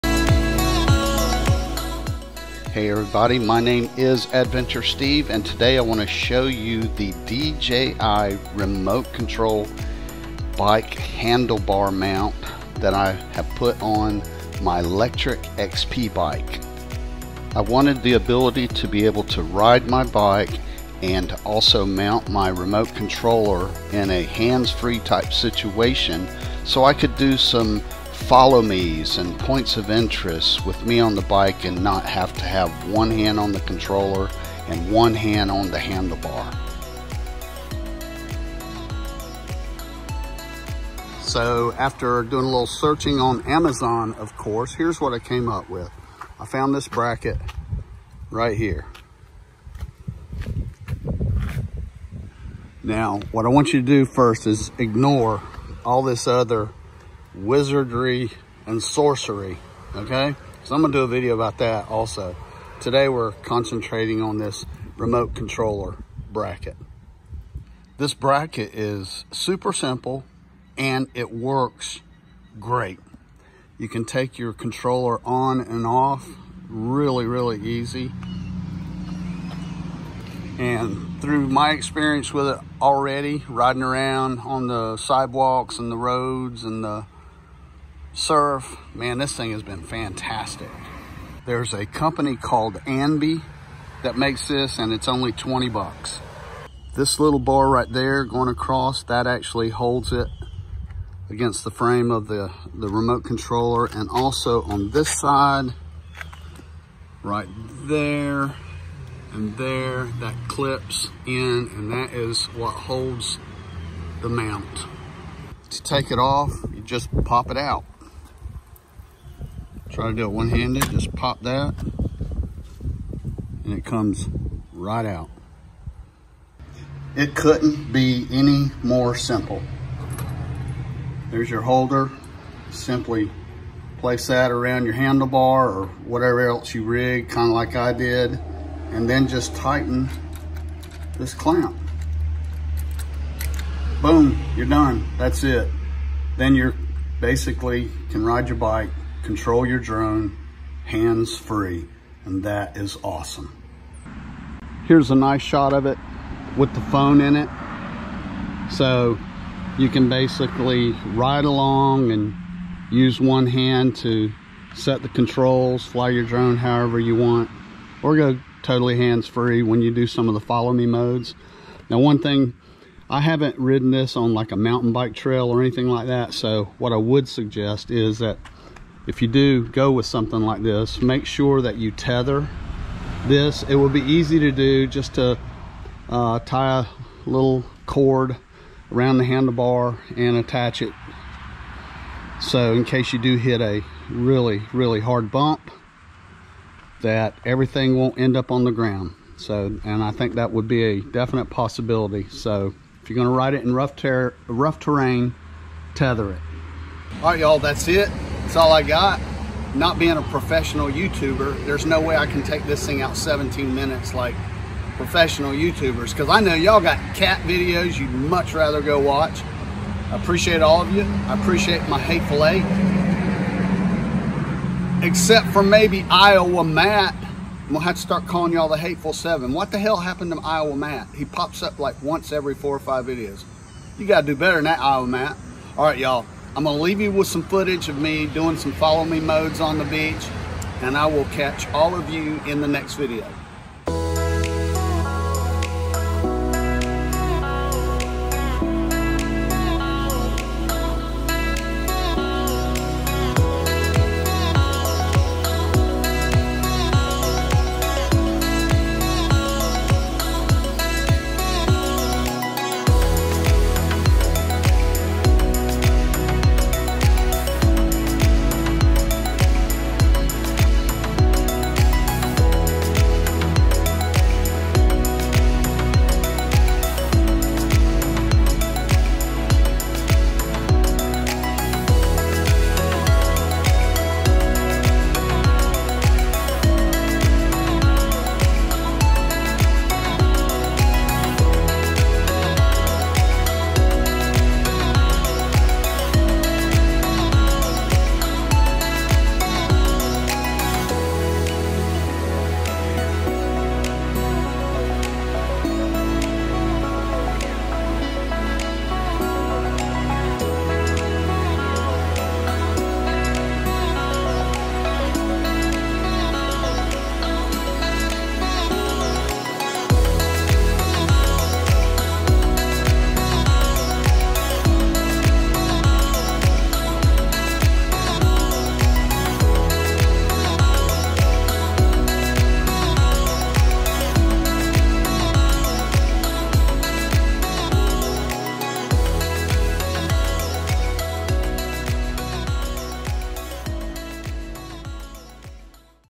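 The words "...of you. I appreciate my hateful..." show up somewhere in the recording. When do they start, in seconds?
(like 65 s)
220 s.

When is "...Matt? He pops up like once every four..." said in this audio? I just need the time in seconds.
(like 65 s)
230 s.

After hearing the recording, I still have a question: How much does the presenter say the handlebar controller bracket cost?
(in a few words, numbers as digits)
$20.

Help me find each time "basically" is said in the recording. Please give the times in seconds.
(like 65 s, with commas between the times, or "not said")
147 s, 160 s.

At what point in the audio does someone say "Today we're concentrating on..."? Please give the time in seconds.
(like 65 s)
62 s.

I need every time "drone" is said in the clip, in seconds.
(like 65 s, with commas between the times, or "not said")
149 s, 166 s.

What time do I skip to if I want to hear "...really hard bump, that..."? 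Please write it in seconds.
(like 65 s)
194 s.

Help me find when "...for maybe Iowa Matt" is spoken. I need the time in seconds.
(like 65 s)
225 s.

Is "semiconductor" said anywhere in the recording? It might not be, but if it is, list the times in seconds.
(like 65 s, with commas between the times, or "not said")
not said.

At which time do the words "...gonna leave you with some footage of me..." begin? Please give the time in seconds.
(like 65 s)
236 s.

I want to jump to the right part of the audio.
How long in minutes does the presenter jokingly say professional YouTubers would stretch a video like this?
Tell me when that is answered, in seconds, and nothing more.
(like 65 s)
213 s.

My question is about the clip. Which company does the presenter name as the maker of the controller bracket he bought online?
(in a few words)
Anby.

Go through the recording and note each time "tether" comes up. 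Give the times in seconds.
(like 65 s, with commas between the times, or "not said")
181 s, 205 s.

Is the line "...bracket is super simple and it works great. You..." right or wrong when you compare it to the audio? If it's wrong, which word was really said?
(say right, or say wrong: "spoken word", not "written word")
right.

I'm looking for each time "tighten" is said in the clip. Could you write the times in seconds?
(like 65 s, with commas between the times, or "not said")
139 s.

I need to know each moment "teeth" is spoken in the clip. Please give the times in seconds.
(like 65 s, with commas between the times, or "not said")
not said.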